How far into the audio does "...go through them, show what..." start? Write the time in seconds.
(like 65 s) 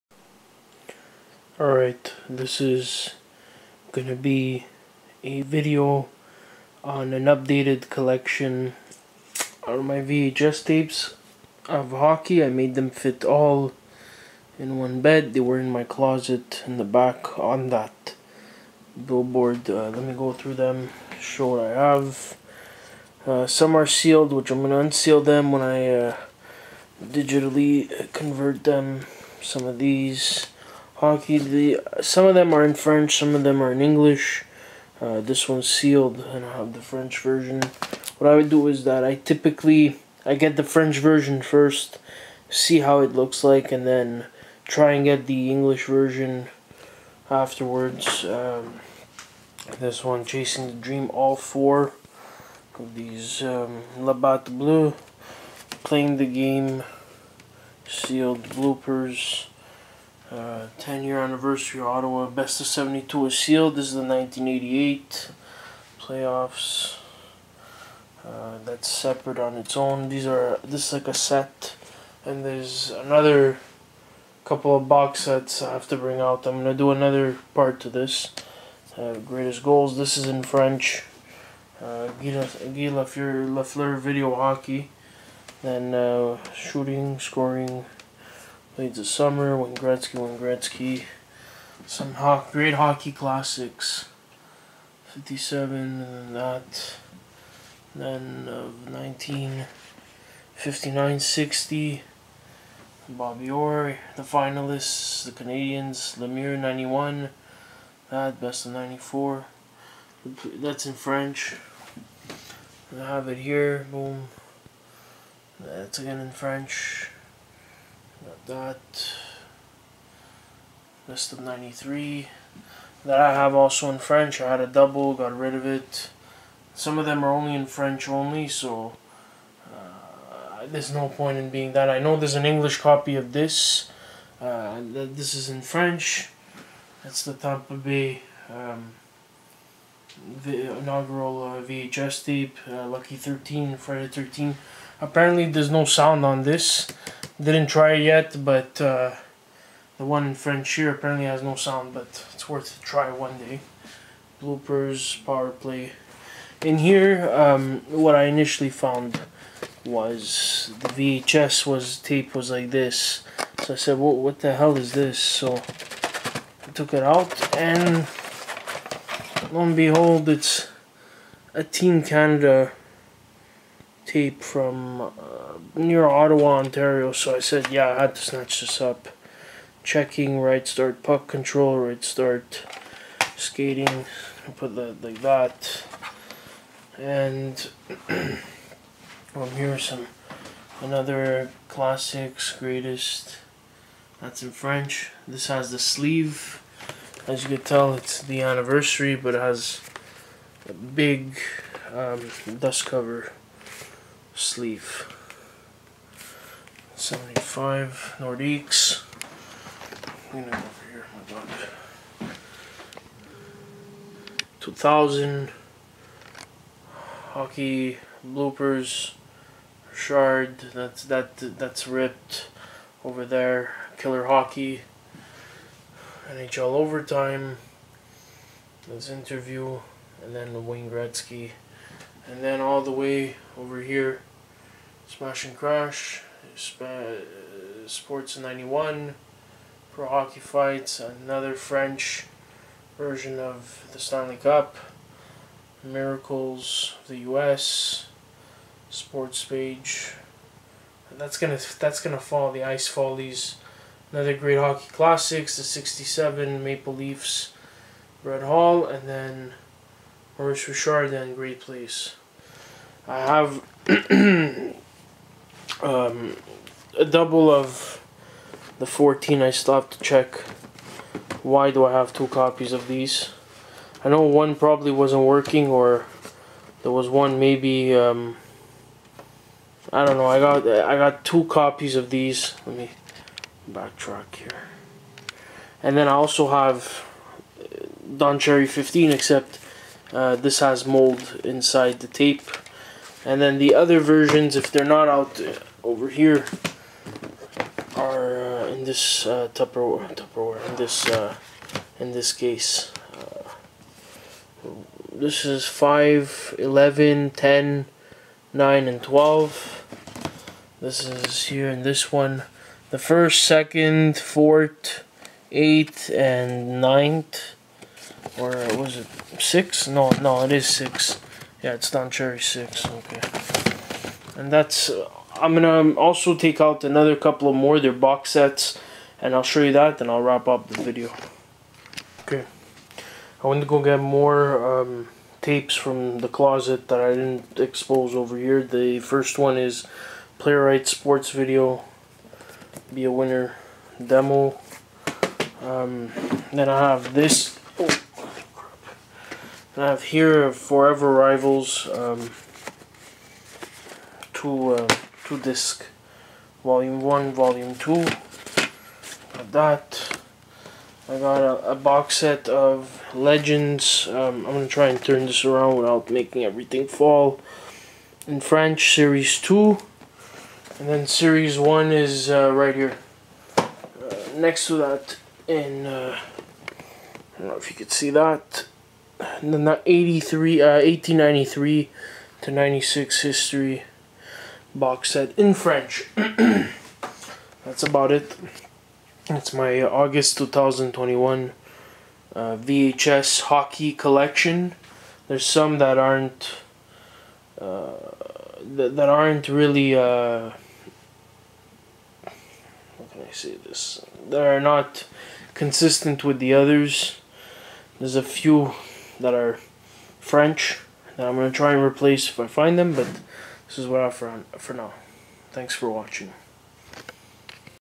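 20 s.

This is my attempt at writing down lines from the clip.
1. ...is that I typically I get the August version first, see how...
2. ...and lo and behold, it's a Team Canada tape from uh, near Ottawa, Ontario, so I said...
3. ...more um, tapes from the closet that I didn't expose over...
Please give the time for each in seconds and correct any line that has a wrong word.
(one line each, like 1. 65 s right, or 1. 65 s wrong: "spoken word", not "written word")
1. 38 s wrong: "French", not "August"
2. 167 s right
3. 333 s right.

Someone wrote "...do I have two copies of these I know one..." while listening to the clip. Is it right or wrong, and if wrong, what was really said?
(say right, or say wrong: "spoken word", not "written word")
right.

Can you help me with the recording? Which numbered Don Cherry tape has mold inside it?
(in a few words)
15.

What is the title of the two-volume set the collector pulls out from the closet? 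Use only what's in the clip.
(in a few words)
Forever Rivals.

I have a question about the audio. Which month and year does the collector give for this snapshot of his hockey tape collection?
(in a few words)
August 2021.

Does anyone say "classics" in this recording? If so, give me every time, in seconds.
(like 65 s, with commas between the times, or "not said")
93 s, 191 s, 254 s.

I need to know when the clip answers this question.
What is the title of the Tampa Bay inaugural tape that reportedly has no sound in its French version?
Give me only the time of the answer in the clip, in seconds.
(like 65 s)
142 s.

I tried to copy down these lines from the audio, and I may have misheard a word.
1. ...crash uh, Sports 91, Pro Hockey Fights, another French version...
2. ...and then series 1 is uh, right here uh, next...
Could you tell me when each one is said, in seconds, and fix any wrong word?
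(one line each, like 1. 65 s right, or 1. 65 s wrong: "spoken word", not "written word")
1. 235 s right
2. 370 s right.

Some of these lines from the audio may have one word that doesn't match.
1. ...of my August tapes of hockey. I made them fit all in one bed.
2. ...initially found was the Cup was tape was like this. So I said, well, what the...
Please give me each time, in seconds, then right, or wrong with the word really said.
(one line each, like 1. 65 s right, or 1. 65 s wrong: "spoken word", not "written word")
1. 9 s wrong: "VHS", not "August"
2. 158 s wrong: "VHS", not "Cup".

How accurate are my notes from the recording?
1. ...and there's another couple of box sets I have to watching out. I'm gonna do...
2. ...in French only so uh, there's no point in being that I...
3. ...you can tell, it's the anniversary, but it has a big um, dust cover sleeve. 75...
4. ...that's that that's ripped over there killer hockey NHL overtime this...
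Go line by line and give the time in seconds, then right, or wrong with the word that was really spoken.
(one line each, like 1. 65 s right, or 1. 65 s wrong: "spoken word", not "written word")
1. 72 s wrong: "bring", not "watching"
2. 127 s right
3. 197 s right
4. 220 s right.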